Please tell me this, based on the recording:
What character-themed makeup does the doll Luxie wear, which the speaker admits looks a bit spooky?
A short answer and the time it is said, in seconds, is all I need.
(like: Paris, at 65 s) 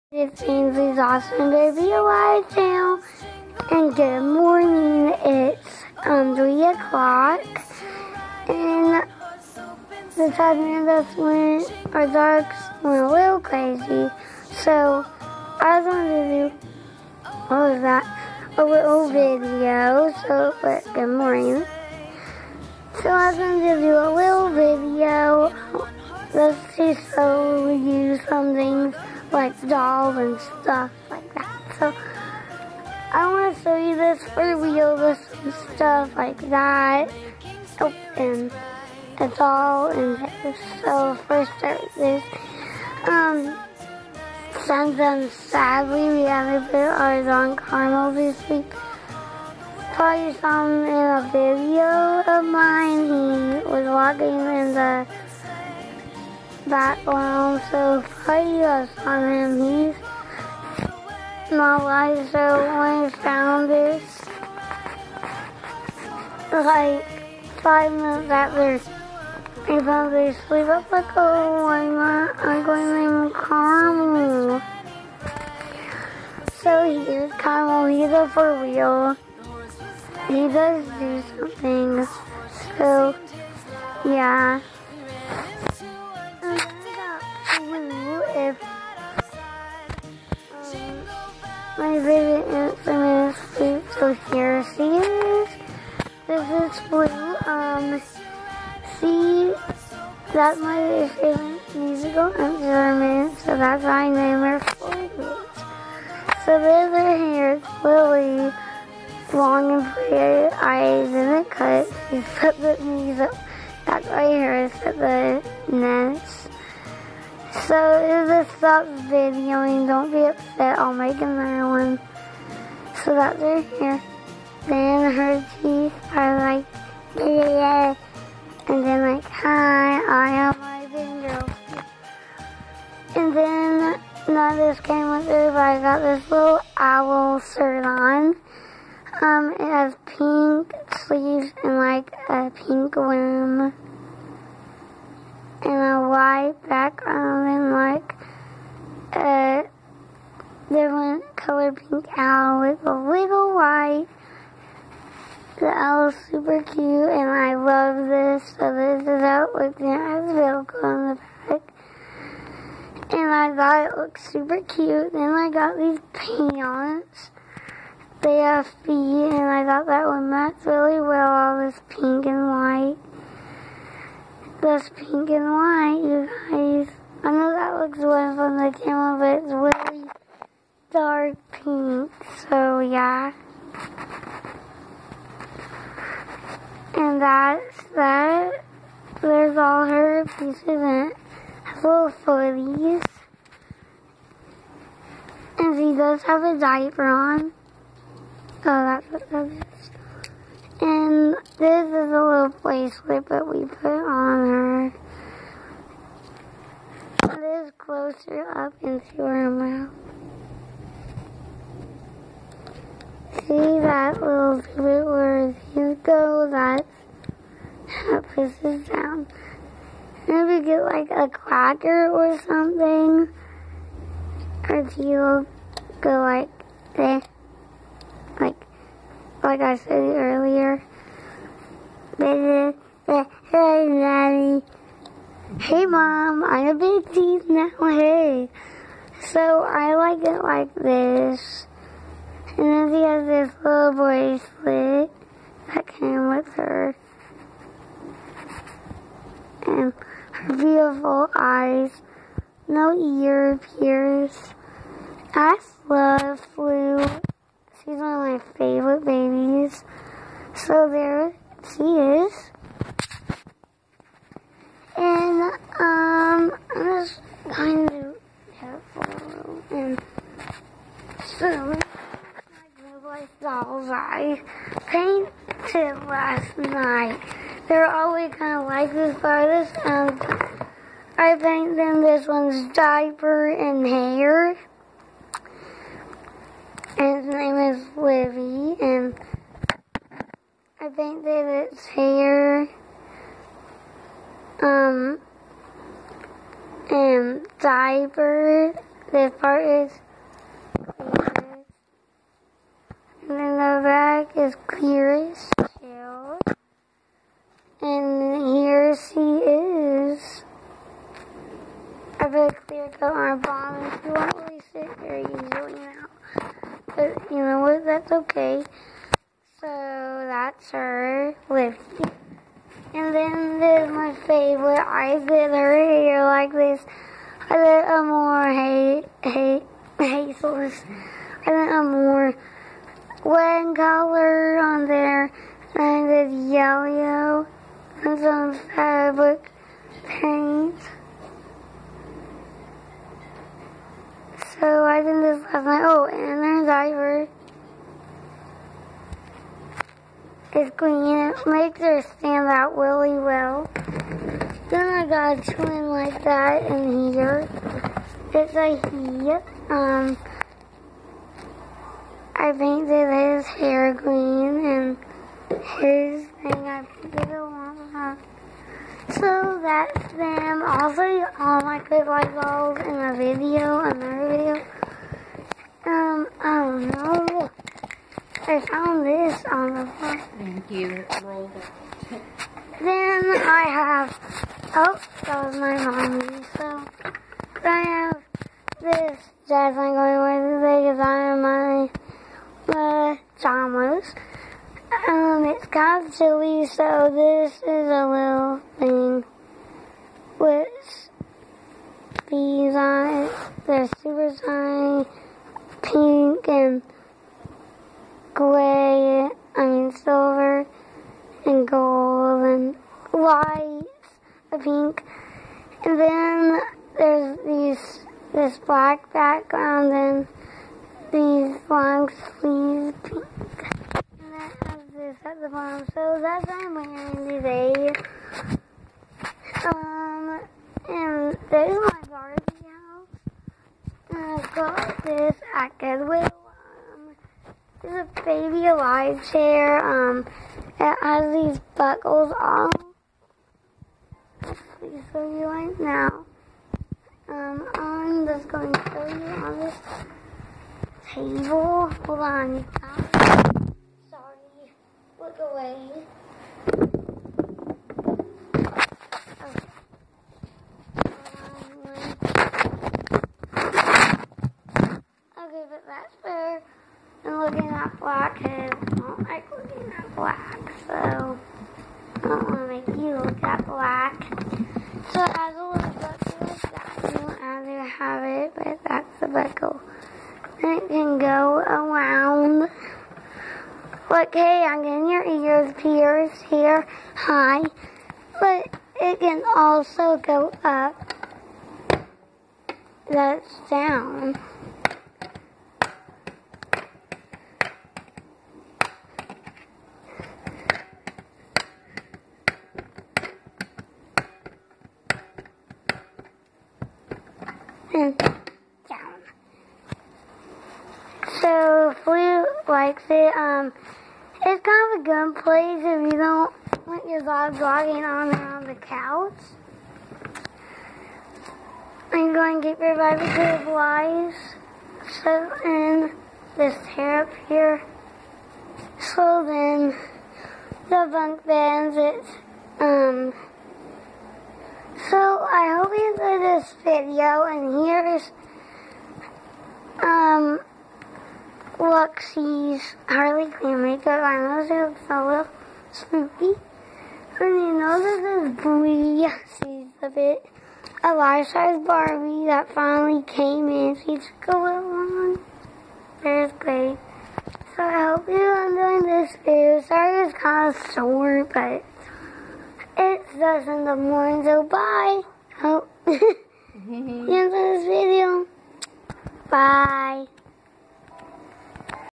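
Harley Quinn, at 543 s.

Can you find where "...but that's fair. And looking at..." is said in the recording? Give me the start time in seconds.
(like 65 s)
465 s.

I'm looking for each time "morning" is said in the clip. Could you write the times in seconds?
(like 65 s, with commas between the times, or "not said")
4 s, 21 s, 563 s.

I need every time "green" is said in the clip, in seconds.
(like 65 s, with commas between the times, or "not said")
350 s, 363 s.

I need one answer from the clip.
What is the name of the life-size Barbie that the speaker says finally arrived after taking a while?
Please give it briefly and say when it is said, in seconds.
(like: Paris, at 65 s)
Bree, at 548 s.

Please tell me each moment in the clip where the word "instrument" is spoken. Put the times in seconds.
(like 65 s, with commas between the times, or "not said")
102 s.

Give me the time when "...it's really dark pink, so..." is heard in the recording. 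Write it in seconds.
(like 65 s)
179 s.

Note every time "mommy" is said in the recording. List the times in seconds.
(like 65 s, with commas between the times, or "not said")
385 s.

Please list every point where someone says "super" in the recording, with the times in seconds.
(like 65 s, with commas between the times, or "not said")
156 s, 164 s, 404 s.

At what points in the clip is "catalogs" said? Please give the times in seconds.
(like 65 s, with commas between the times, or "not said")
not said.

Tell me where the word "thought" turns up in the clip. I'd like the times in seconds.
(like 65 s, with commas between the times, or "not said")
163 s, 169 s.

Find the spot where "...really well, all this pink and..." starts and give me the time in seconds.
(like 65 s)
170 s.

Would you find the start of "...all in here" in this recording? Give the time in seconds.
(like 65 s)
39 s.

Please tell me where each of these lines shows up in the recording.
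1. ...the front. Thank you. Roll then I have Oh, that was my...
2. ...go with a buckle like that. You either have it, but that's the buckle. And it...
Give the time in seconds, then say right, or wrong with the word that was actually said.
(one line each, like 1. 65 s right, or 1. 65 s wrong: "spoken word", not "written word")
1. 379 s right
2. 475 s right.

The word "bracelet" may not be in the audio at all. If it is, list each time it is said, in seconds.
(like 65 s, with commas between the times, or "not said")
202 s, 243 s.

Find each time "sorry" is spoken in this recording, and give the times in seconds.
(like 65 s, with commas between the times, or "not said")
454 s, 559 s.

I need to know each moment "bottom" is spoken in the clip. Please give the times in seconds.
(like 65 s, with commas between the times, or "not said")
313 s, 425 s.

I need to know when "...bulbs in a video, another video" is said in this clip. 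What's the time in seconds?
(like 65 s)
372 s.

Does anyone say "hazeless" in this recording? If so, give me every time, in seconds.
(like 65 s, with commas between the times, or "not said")
329 s.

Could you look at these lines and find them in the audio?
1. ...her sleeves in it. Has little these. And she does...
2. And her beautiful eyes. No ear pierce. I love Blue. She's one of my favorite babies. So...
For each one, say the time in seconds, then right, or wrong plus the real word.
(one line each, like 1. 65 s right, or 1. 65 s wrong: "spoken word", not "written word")
1. 189 s wrong: "pieces", not "sleeves"
2. 249 s right.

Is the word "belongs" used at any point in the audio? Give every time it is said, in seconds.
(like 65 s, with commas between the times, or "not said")
not said.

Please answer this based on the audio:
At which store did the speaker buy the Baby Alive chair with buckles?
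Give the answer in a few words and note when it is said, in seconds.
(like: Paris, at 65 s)
Goodwill, at 435 s.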